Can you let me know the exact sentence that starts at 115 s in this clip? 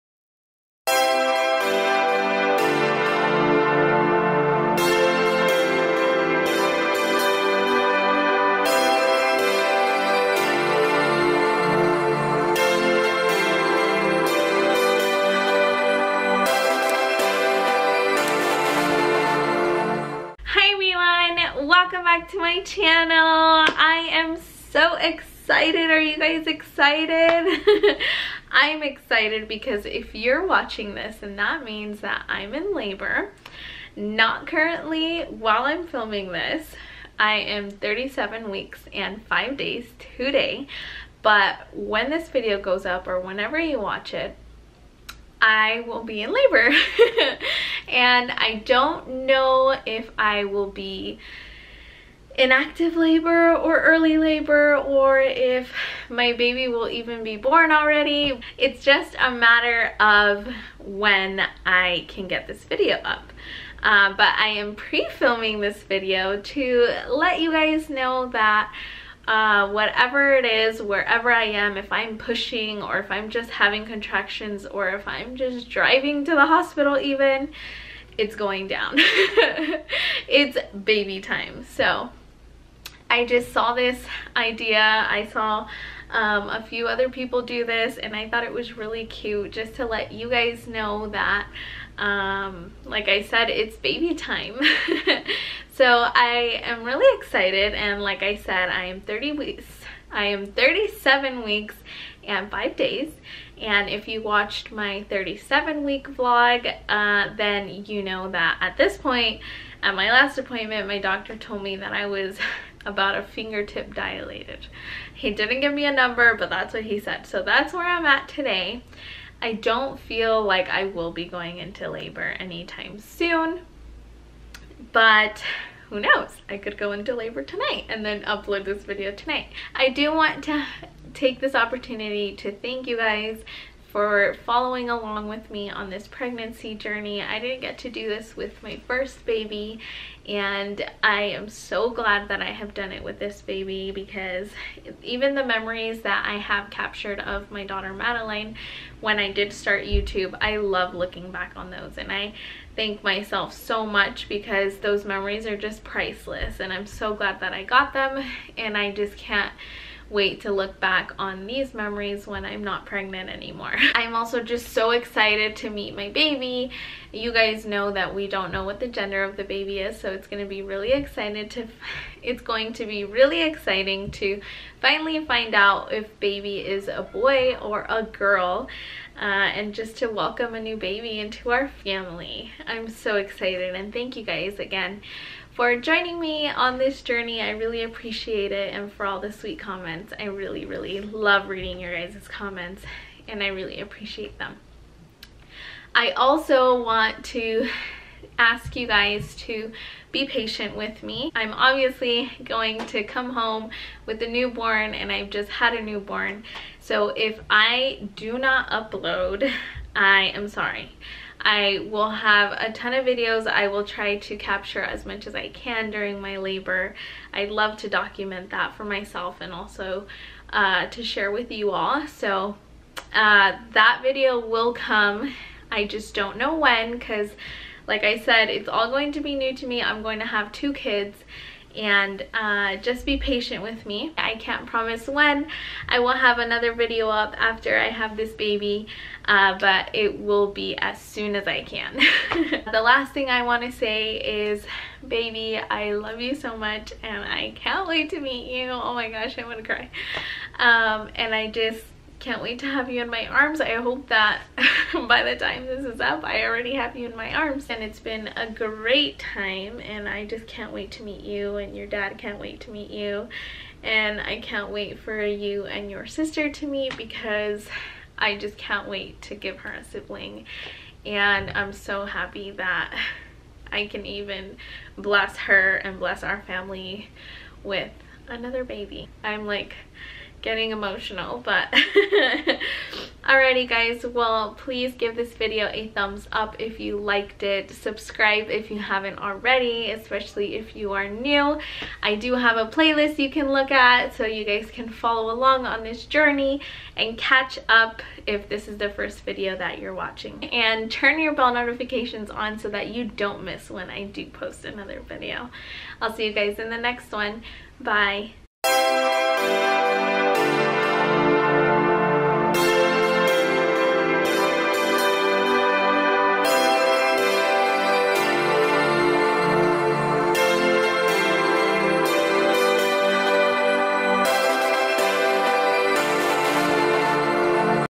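He didn't give me a number, but that's what he said.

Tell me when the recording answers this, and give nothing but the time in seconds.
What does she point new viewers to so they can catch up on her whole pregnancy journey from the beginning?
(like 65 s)
292 s.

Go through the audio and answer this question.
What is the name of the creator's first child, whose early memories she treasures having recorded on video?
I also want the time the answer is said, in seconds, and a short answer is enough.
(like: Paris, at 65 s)
Madeline, at 147 s.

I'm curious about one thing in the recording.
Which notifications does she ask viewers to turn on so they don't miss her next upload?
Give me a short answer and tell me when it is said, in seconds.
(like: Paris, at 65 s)
Bell notifications, at 301 s.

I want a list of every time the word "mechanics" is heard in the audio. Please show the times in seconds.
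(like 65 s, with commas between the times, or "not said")
not said.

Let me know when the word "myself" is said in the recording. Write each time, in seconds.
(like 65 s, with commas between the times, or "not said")
153 s, 218 s.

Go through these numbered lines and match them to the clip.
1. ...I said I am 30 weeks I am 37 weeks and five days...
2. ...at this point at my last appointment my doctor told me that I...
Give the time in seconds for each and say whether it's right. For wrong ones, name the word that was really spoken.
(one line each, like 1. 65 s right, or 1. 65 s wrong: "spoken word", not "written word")
1. 98 s right
2. 108 s right.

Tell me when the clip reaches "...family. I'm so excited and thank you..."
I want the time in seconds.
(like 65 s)
181 s.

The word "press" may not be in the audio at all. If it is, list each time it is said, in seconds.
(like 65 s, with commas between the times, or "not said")
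not said.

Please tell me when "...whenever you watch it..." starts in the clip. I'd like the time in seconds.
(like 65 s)
43 s.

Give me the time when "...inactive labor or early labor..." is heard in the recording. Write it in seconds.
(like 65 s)
52 s.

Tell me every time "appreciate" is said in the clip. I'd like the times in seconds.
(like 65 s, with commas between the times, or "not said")
187 s, 193 s.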